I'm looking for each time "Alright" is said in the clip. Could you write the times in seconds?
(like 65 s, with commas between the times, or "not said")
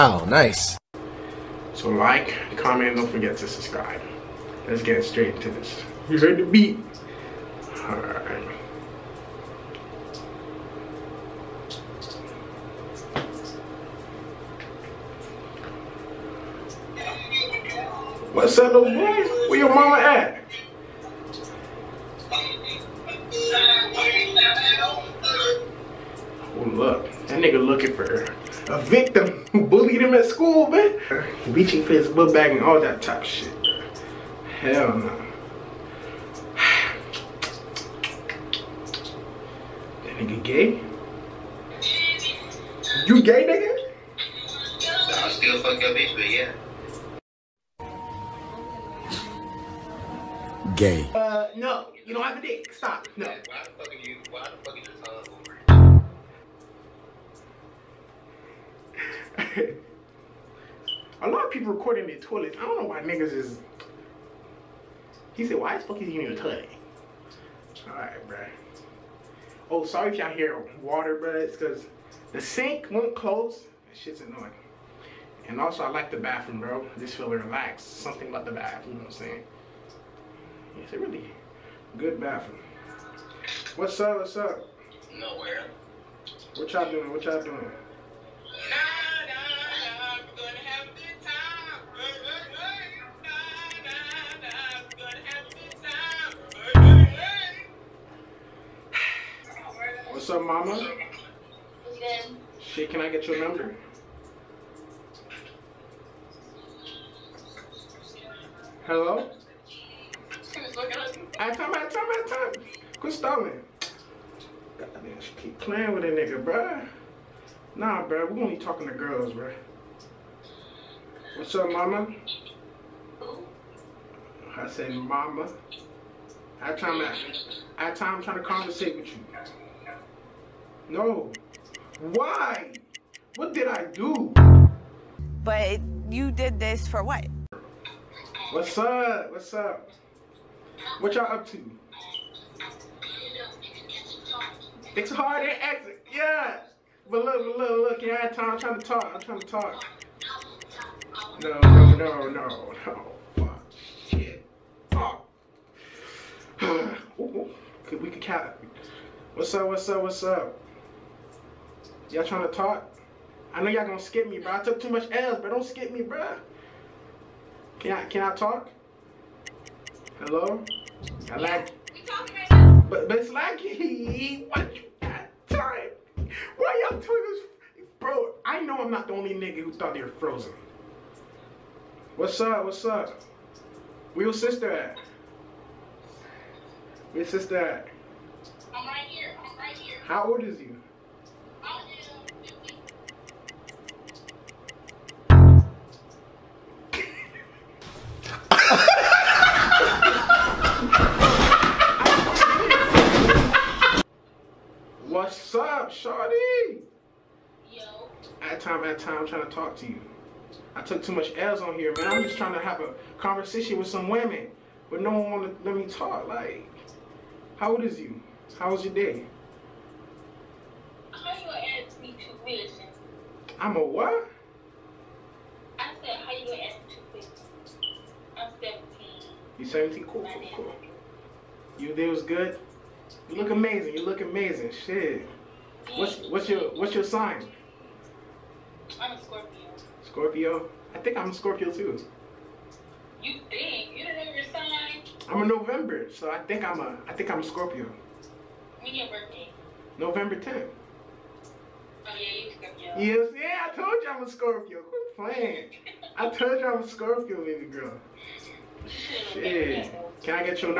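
7 s, 67 s.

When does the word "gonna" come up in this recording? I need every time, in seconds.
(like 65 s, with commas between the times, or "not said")
163 s, 221 s, 226 s.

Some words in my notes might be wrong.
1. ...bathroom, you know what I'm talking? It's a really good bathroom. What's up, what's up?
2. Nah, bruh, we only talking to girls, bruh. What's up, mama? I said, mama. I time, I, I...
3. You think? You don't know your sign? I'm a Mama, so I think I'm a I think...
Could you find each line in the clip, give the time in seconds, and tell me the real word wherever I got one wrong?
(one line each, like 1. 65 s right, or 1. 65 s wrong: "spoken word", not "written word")
1. 78 s wrong: "saying", not "talking"
2. 117 s right
3. 243 s wrong: "November", not "Mama".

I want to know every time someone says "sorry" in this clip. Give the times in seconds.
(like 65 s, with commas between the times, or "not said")
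69 s.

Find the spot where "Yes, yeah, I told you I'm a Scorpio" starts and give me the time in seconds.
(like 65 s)
253 s.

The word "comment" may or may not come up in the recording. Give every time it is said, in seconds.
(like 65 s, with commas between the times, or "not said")
2 s.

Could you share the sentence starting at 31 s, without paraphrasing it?
Reaching for his book bag and all that type of shit.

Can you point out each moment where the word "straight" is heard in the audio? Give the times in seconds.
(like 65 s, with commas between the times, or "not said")
5 s.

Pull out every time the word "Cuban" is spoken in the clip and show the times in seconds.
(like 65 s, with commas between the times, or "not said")
not said.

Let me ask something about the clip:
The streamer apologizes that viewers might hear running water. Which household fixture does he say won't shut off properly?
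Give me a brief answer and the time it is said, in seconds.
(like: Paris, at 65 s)
sink, at 72 s.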